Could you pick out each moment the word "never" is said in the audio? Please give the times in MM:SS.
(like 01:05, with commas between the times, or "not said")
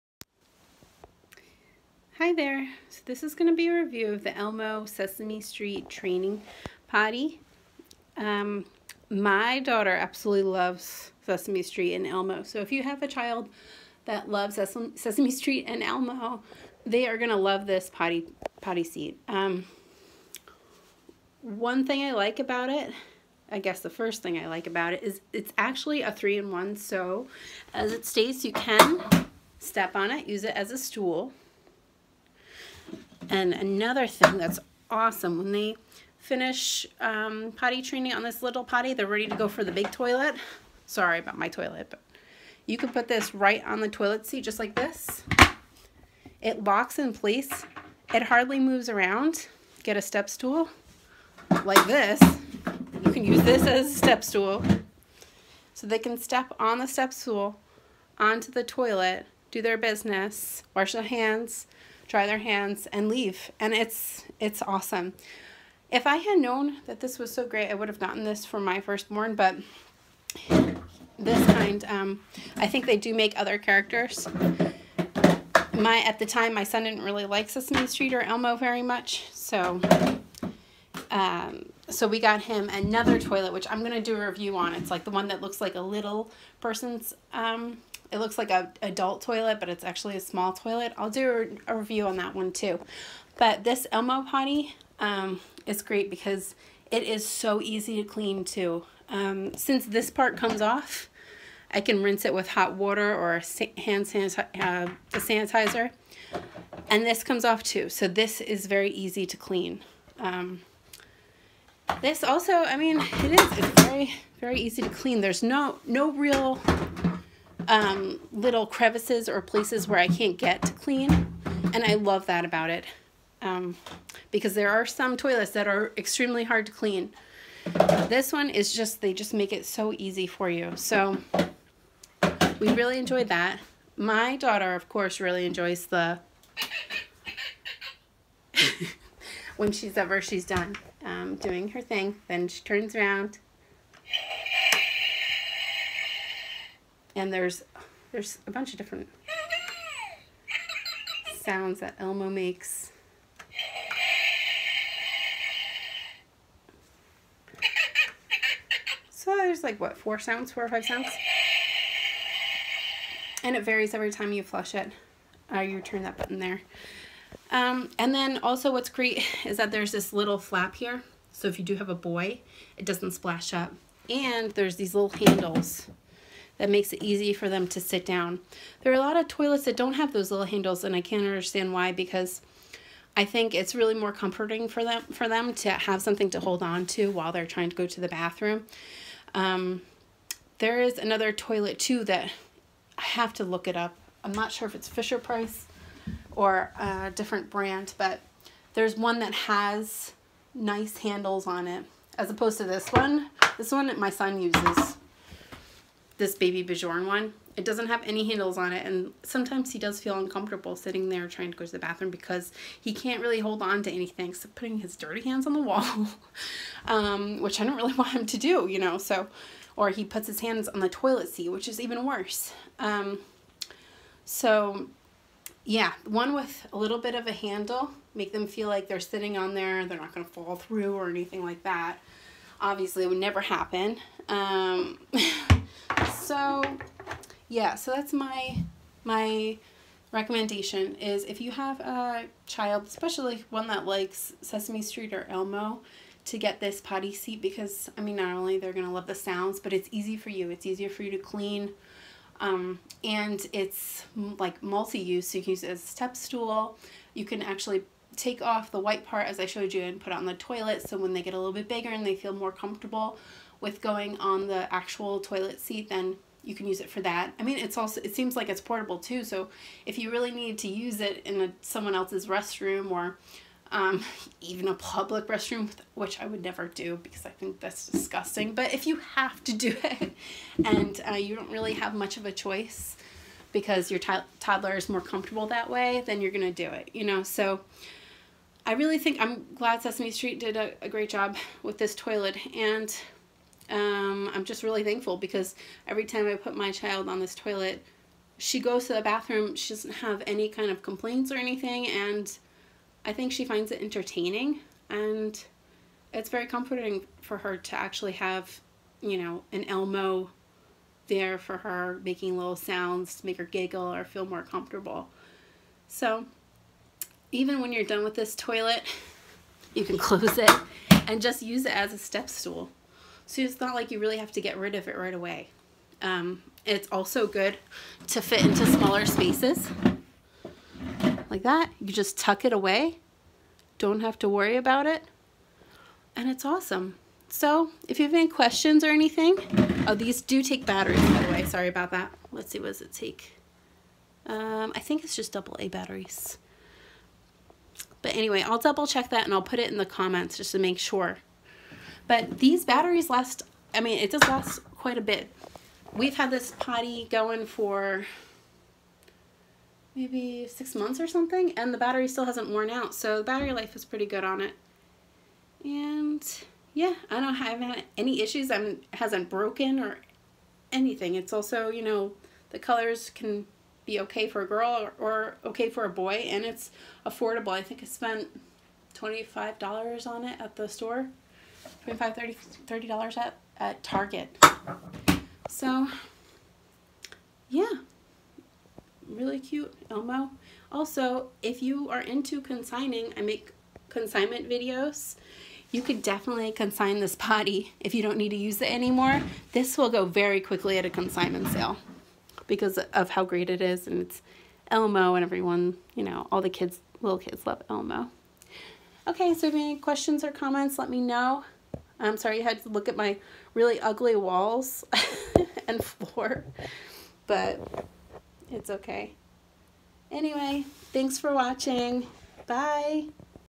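03:53, 04:36.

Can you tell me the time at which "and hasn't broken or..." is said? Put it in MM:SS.
06:08.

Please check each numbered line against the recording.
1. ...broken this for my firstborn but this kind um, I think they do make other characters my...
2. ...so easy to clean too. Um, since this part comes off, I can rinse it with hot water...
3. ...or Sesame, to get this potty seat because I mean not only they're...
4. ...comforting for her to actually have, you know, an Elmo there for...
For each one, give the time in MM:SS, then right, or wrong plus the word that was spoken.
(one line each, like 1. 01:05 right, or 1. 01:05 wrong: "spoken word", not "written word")
1. 01:07 wrong: "gotten", not "broken"
2. 01:37 right
3. 04:05 wrong: "Elmo", not "Sesame"
4. 05:06 right.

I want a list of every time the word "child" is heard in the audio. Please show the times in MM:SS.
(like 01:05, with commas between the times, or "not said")
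00:13, 04:02, 04:56.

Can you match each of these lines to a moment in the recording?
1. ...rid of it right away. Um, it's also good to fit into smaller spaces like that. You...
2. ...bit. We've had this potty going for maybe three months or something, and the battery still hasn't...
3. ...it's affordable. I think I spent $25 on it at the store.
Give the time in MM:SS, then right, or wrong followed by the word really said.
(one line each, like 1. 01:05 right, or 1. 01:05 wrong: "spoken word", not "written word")
1. 05:24 right
2. 05:55 wrong: "six", not "three"
3. 06:16 right.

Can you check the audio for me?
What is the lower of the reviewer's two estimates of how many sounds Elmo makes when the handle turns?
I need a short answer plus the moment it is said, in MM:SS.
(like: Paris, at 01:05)
4, at 02:39.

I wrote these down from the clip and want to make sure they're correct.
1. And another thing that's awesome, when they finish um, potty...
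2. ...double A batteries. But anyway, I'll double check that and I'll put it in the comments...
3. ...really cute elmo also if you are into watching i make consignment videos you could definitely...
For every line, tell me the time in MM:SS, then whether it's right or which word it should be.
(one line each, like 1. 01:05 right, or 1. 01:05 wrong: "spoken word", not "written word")
1. 00:33 right
2. 05:45 right
3. 06:29 wrong: "consigning", not "watching".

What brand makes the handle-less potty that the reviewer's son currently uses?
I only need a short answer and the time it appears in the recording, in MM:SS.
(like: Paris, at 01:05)
BabyBjörn, at 03:26.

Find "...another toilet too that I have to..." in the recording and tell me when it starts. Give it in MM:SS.
03:10.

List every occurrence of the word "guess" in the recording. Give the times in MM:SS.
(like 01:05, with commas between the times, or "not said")
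00:23.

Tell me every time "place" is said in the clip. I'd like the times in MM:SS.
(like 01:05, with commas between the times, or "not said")
00:47, 01:59.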